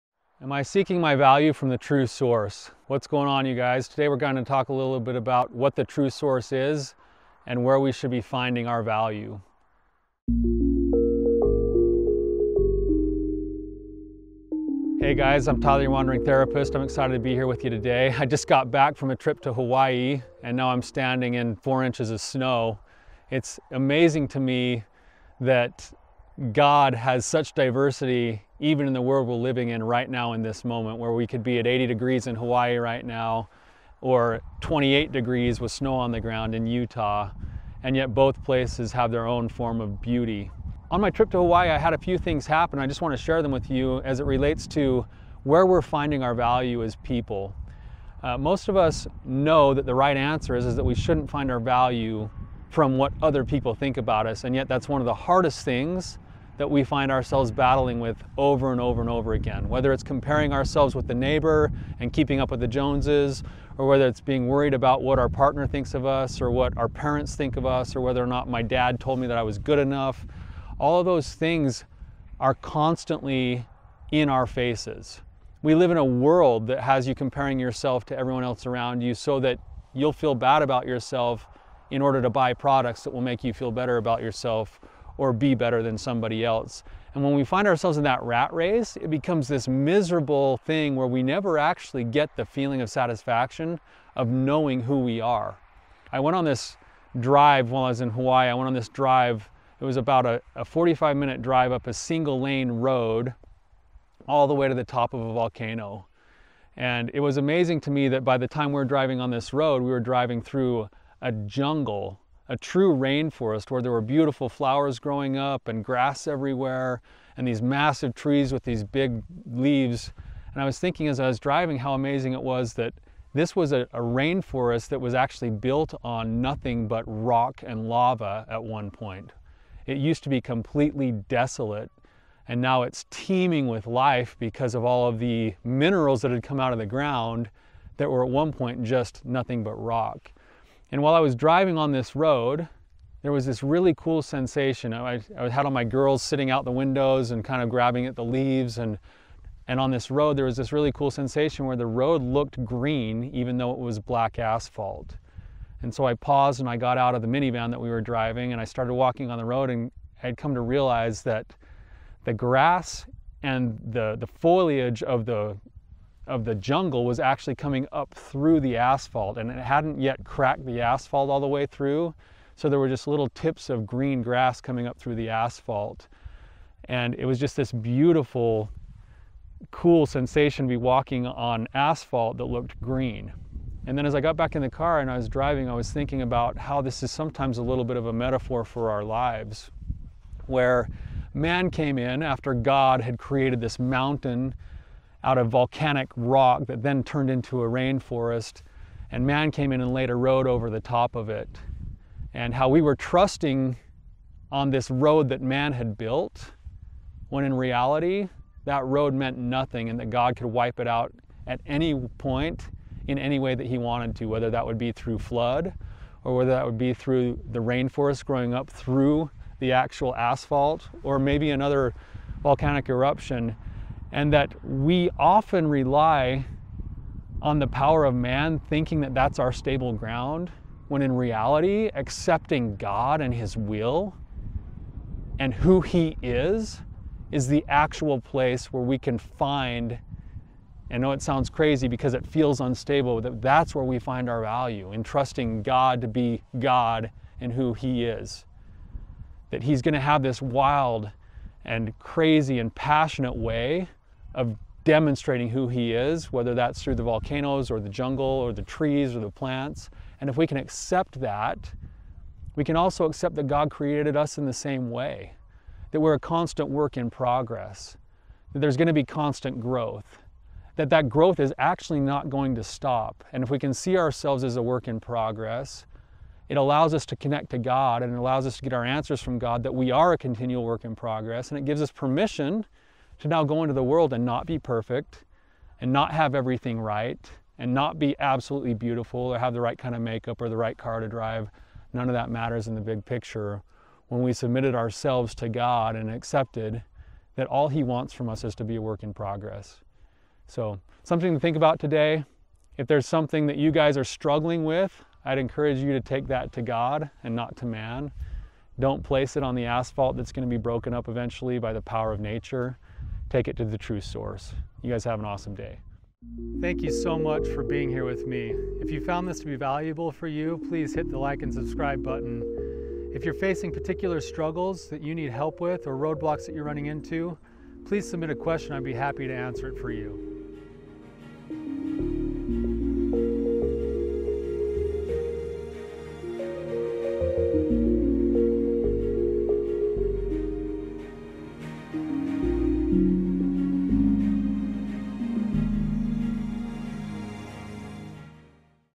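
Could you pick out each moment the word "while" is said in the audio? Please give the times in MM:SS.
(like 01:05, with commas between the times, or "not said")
01:37, 02:21.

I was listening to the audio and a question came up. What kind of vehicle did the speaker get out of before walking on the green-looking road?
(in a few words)
minivan.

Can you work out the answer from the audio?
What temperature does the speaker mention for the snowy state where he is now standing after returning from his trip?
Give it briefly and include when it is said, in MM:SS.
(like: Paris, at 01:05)
28 degrees, at 00:34.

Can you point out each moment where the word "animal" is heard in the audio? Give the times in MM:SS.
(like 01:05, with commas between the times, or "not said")
not said.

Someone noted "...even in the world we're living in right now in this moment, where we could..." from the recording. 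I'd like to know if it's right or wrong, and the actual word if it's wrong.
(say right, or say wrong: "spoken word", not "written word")
right.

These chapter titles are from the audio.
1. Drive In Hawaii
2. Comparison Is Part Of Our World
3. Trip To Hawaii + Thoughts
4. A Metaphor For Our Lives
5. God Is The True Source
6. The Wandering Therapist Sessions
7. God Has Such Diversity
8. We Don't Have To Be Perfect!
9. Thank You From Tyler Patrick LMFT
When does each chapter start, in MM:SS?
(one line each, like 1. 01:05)
1. 01:35
2. 01:15
3. 00:40
4. 03:03
5. 03:53
6. 00:10
7. 00:26
8. 04:46
9. 05:15.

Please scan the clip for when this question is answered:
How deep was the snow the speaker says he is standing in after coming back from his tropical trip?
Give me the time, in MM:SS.
00:21.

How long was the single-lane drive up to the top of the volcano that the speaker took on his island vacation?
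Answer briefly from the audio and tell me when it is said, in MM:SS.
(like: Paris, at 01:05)
45 minutes, at 01:40.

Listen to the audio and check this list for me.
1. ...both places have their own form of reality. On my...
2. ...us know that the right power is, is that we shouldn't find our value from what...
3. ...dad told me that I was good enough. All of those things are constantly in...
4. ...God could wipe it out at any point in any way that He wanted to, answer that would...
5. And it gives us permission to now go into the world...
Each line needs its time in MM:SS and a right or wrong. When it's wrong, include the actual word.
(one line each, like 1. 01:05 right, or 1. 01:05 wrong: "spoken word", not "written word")
1. 00:38 wrong: "beauty", not "reality"
2. 00:48 wrong: "answer", not "power"
3. 01:08 right
4. 03:30 wrong: "whether", not "answer"
5. 04:41 right.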